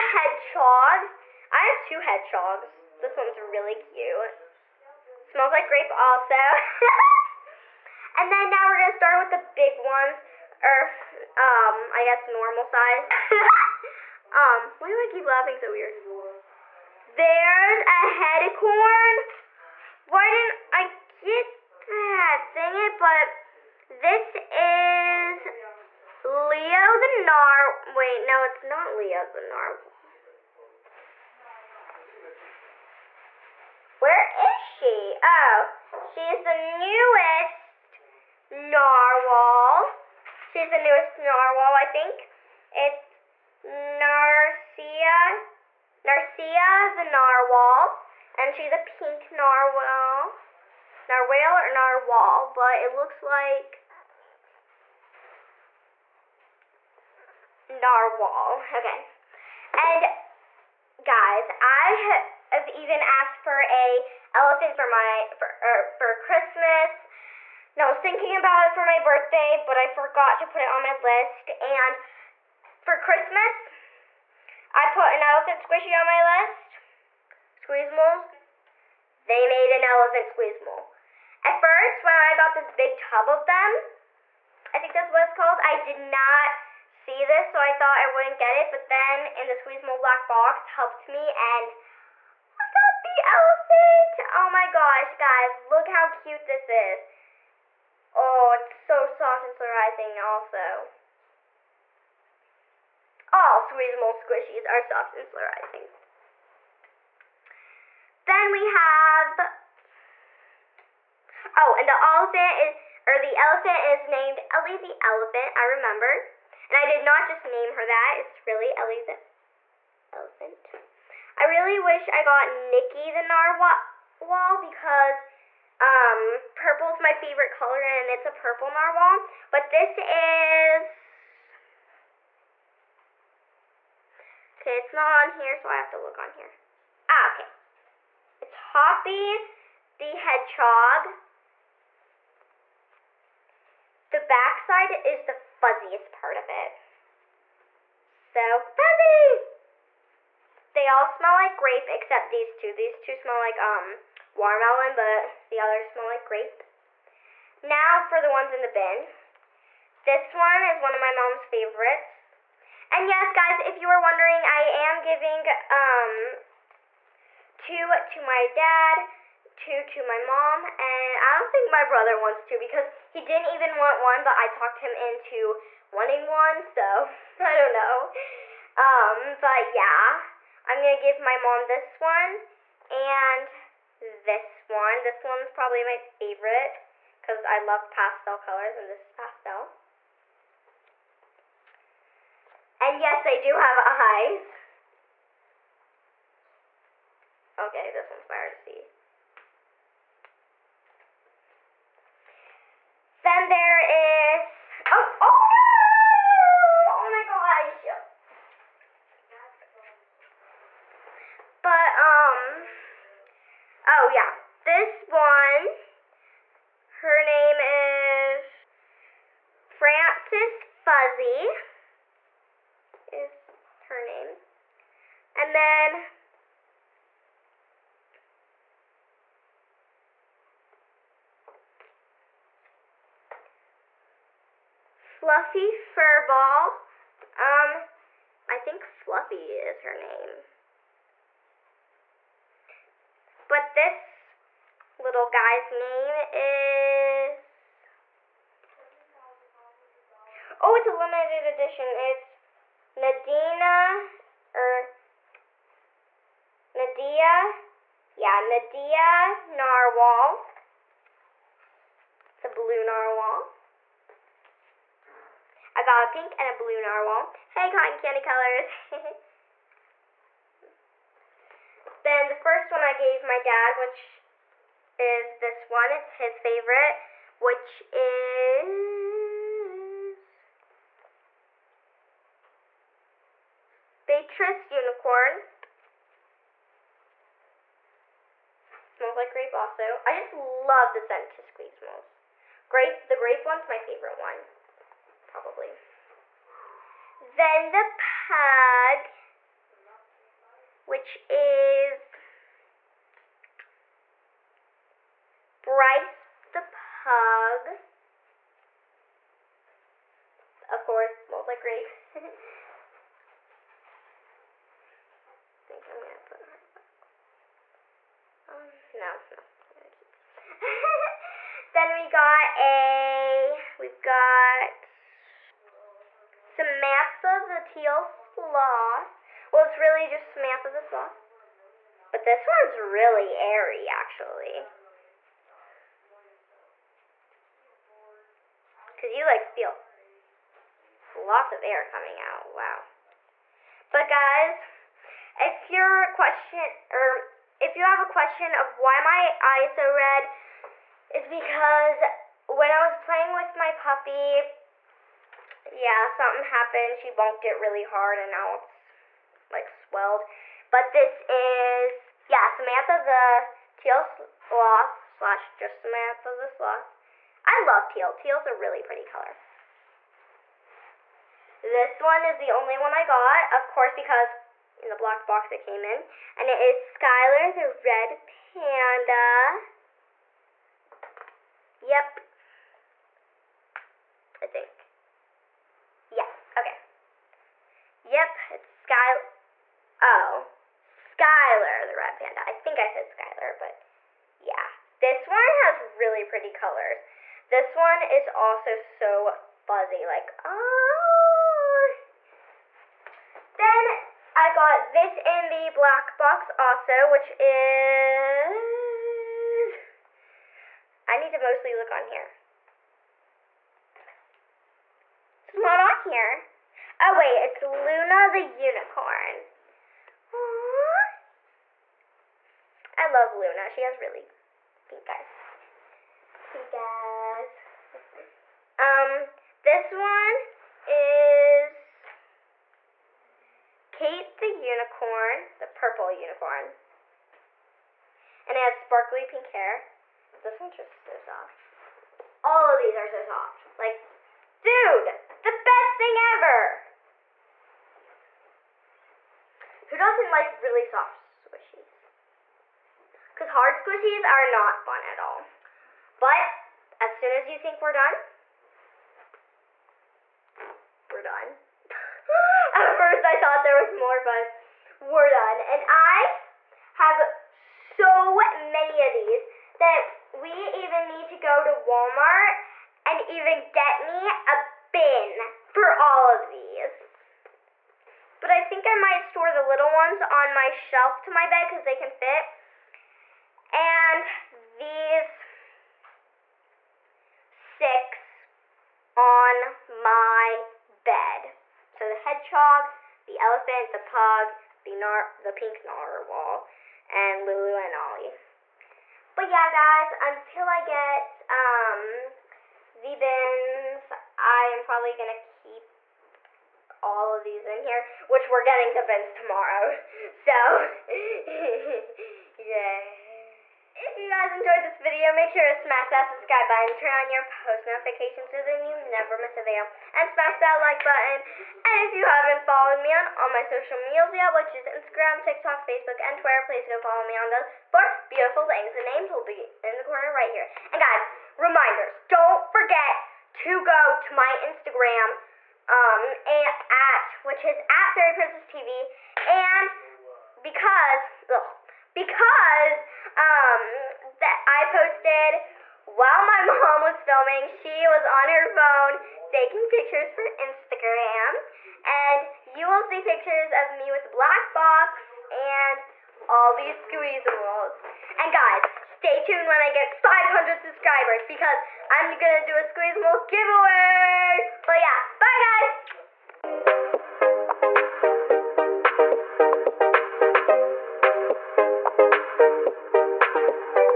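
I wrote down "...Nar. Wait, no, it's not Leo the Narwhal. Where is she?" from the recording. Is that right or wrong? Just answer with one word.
right.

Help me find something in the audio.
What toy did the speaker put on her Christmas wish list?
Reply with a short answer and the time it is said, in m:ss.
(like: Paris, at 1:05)
Elephant squishy, at 1:15.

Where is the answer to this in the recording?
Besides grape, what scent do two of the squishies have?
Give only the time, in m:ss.
2:34.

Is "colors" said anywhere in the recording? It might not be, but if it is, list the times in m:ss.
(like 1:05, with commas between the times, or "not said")
2:07, 3:08, 4:28, 6:09, 6:36.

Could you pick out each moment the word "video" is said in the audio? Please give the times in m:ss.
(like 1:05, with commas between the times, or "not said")
8:34, 8:39.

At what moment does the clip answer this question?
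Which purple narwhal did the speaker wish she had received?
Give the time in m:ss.
2:02.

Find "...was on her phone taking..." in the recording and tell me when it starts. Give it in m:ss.
9:08.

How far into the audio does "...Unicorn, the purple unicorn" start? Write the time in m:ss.
7:14.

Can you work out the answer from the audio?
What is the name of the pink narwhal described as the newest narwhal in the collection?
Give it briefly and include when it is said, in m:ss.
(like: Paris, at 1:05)
Narcia, at 0:46.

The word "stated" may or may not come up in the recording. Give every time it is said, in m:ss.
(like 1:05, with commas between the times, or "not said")
not said.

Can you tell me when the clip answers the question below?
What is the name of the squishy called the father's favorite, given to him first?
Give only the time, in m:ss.
4:44.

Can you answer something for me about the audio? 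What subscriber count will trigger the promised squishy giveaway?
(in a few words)
500.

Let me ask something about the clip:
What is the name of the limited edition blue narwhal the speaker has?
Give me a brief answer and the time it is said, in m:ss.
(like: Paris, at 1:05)
Nadia Narwhal, at 4:18.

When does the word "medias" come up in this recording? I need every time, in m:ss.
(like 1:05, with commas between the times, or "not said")
8:43.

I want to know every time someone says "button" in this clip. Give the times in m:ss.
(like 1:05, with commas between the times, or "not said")
8:36, 8:41.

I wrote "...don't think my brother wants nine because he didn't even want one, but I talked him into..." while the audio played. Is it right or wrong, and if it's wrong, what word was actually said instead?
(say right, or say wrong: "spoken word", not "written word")
wrong: "two", not "nine".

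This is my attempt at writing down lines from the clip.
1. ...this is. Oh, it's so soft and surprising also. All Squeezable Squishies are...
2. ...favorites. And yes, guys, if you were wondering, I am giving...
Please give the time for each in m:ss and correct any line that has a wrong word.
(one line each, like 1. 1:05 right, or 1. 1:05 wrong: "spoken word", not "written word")
1. 1:36 right
2. 2:41 right.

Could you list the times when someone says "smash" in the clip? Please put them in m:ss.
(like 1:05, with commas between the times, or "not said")
8:35, 8:40.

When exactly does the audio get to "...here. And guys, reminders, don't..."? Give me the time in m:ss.
8:50.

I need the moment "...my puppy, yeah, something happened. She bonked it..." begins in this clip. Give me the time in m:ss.
5:53.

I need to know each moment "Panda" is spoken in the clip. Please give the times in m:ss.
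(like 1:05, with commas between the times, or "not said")
6:18, 6:32.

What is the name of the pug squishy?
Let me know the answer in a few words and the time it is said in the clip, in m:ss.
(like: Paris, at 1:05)
Bryce, at 5:05.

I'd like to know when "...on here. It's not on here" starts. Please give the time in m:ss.
6:51.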